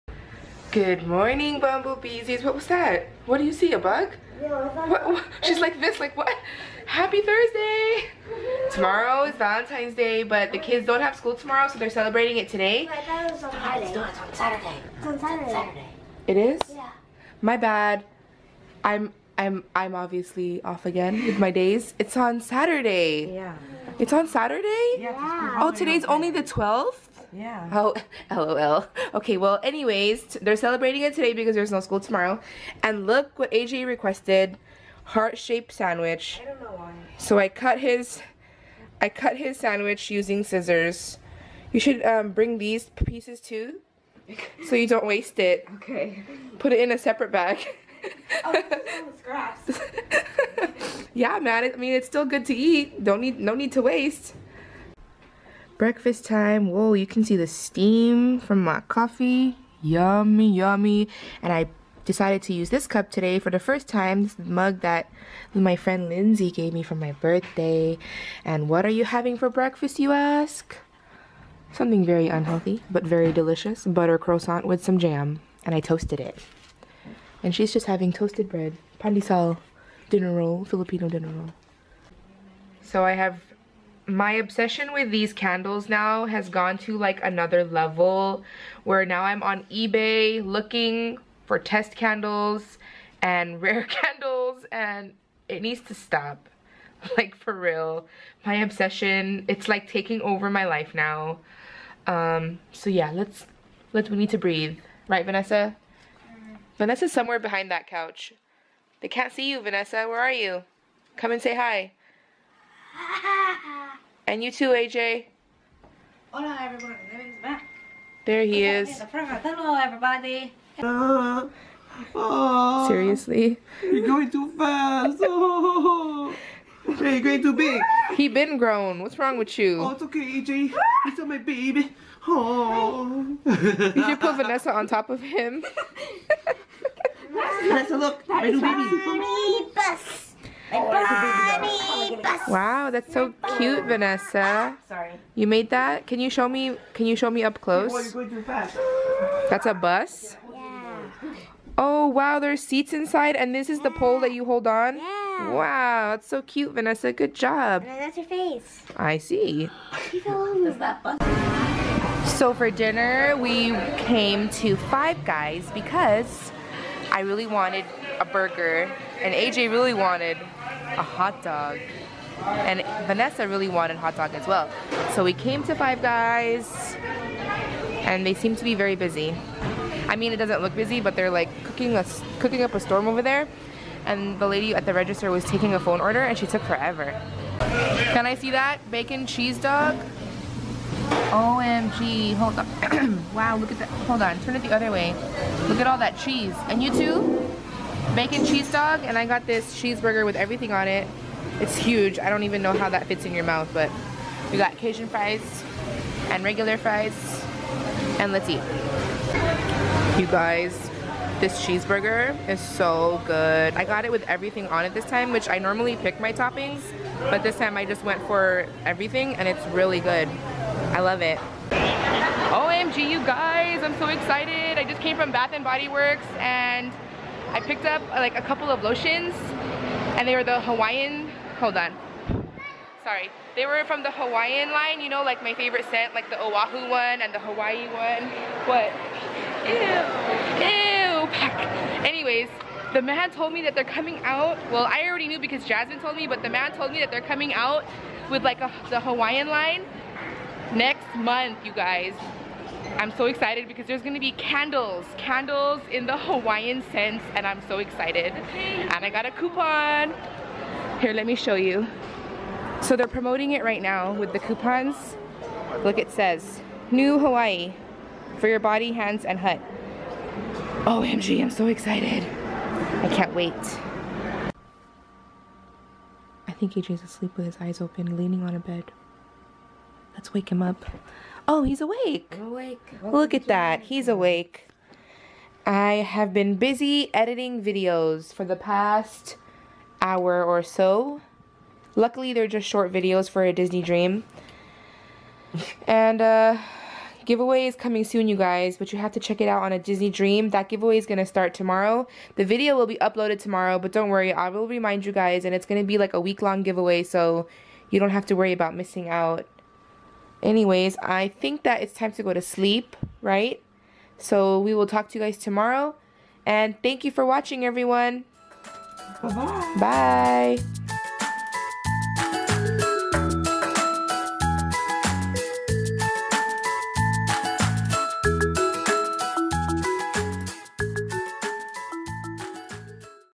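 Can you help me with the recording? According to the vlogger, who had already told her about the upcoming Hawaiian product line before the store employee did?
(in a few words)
Jasmine.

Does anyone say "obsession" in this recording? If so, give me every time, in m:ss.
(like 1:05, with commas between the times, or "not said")
1:24, 1:38.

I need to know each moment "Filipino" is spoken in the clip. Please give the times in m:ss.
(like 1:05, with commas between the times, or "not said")
1:20.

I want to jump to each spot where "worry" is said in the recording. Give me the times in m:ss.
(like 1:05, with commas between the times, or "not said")
5:04, 5:08.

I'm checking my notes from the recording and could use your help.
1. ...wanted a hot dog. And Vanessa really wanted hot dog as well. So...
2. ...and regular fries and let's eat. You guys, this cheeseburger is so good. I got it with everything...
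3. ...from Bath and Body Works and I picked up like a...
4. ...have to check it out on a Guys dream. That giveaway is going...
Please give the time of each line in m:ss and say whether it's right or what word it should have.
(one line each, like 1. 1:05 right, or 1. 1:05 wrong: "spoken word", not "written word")
1. 2:49 right
2. 3:26 right
3. 3:45 right
4. 4:58 wrong: "Disney", not "Guys".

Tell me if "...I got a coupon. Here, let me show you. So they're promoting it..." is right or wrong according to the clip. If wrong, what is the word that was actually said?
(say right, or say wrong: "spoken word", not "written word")
right.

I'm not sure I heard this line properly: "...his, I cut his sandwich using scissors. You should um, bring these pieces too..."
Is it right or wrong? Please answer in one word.
right.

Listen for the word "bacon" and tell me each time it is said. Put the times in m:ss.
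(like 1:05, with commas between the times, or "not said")
3:08, 3:18.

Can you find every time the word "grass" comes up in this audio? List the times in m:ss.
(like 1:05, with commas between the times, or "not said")
0:49.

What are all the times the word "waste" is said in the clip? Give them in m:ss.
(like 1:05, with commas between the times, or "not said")
0:45, 0:53.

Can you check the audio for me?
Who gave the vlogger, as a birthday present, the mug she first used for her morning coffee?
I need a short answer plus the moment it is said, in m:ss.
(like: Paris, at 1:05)
Lindsay, at 1:06.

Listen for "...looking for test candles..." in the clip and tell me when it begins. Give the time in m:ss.
1:30.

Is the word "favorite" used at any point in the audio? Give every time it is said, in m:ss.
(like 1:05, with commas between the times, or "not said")
3:55.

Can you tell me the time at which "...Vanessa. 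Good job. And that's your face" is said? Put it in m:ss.
2:36.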